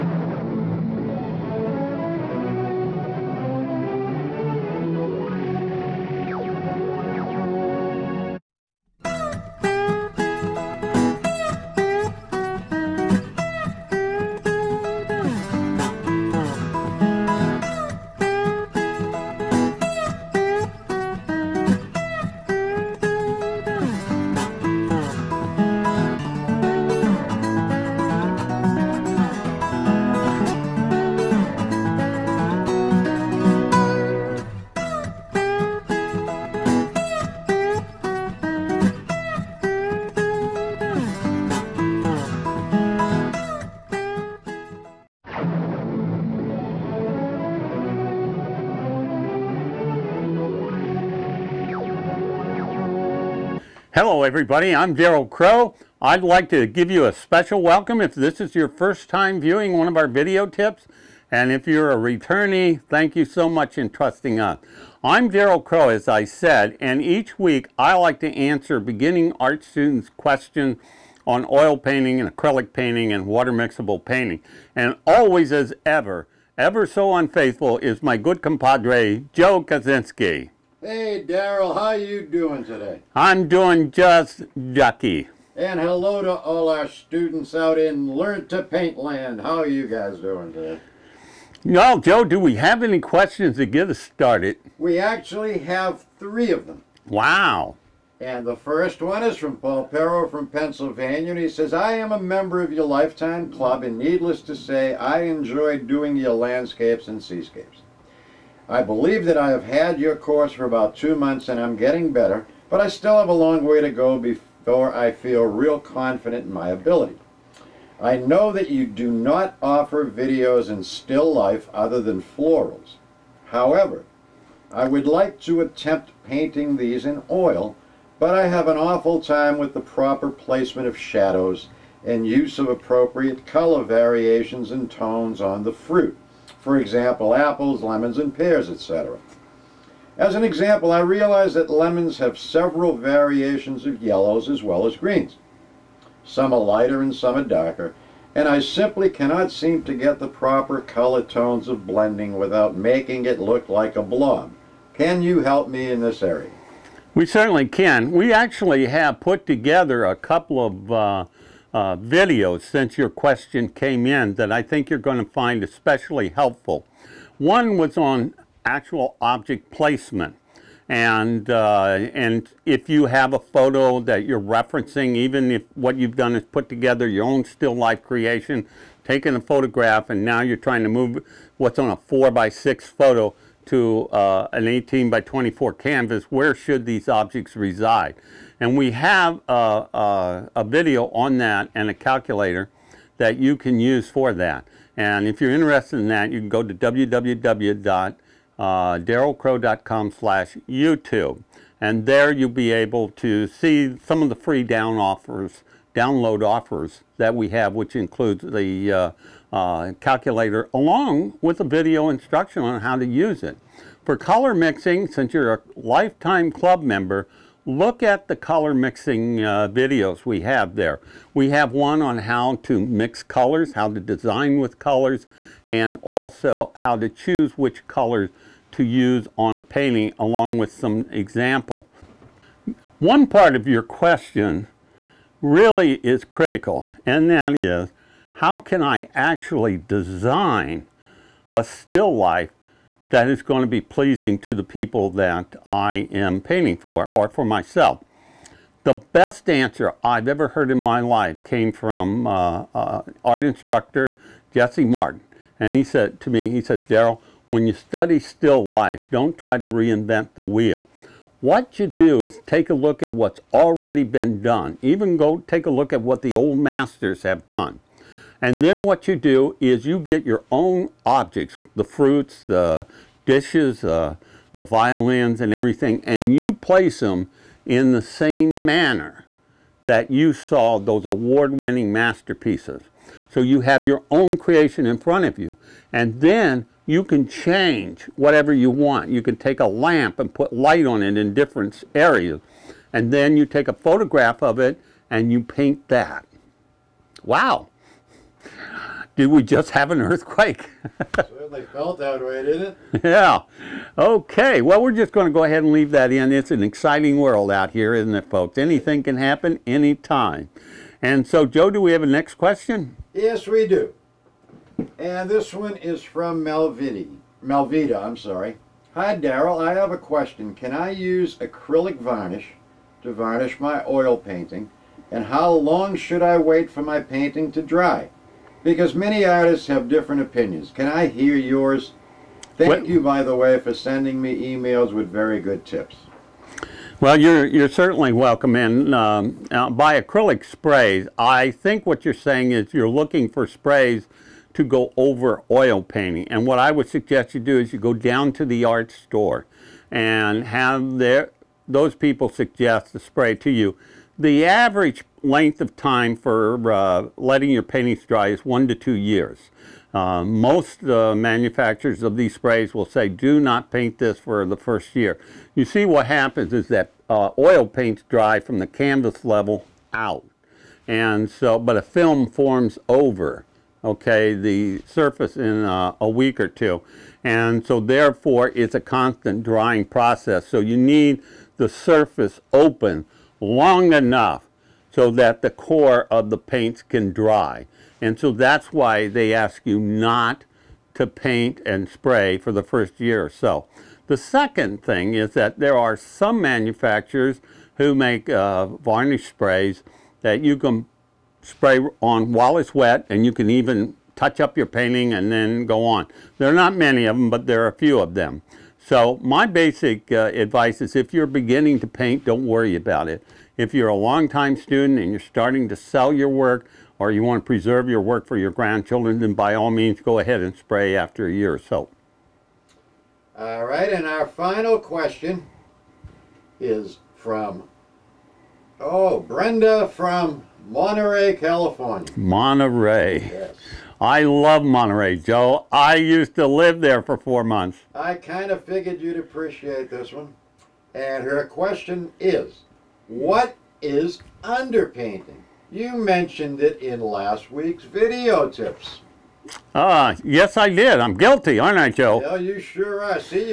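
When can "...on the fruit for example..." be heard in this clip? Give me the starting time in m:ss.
2:15.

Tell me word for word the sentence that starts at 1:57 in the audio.
I know that you do not offer videos in still life other than florals.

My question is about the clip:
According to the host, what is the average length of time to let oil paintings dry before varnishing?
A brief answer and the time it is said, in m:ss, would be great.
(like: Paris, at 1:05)
1 to 2 years, at 5:58.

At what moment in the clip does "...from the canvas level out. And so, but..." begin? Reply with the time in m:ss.
6:08.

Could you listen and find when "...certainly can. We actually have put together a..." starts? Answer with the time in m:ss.
2:37.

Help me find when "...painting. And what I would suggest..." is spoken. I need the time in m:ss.
5:45.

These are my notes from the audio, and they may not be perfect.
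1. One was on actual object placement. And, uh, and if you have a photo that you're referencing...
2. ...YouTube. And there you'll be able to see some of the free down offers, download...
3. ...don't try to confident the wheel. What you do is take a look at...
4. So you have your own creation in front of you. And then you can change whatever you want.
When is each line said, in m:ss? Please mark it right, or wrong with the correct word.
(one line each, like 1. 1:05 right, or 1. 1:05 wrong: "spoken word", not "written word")
1. 2:47 right
2. 3:20 right
3. 4:19 wrong: "reinvent", not "confident"
4. 4:43 right.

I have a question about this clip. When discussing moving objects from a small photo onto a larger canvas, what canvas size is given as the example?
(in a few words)
18 by 24.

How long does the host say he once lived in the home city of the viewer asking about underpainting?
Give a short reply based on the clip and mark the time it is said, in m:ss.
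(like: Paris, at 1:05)
4 months, at 7:17.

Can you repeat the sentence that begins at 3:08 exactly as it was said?
And we have a, uh, uh, a video on that and a calculator that you can use for that.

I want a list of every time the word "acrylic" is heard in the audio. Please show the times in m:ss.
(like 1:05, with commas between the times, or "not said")
1:12, 5:21, 5:40.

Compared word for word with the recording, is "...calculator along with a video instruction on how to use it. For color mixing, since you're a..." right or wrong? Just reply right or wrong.
right.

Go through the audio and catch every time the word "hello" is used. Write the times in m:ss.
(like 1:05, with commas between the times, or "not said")
0:54, 1:25.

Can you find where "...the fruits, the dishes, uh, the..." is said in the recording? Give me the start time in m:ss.
4:31.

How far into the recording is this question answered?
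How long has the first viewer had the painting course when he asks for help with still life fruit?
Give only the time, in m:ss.
1:50.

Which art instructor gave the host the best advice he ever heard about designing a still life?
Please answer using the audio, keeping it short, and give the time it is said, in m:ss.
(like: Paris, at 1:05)
Jesse Martin, at 4:14.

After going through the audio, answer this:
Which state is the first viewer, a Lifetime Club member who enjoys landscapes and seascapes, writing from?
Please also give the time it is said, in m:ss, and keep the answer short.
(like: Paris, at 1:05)
Pennsylvania, at 1:40.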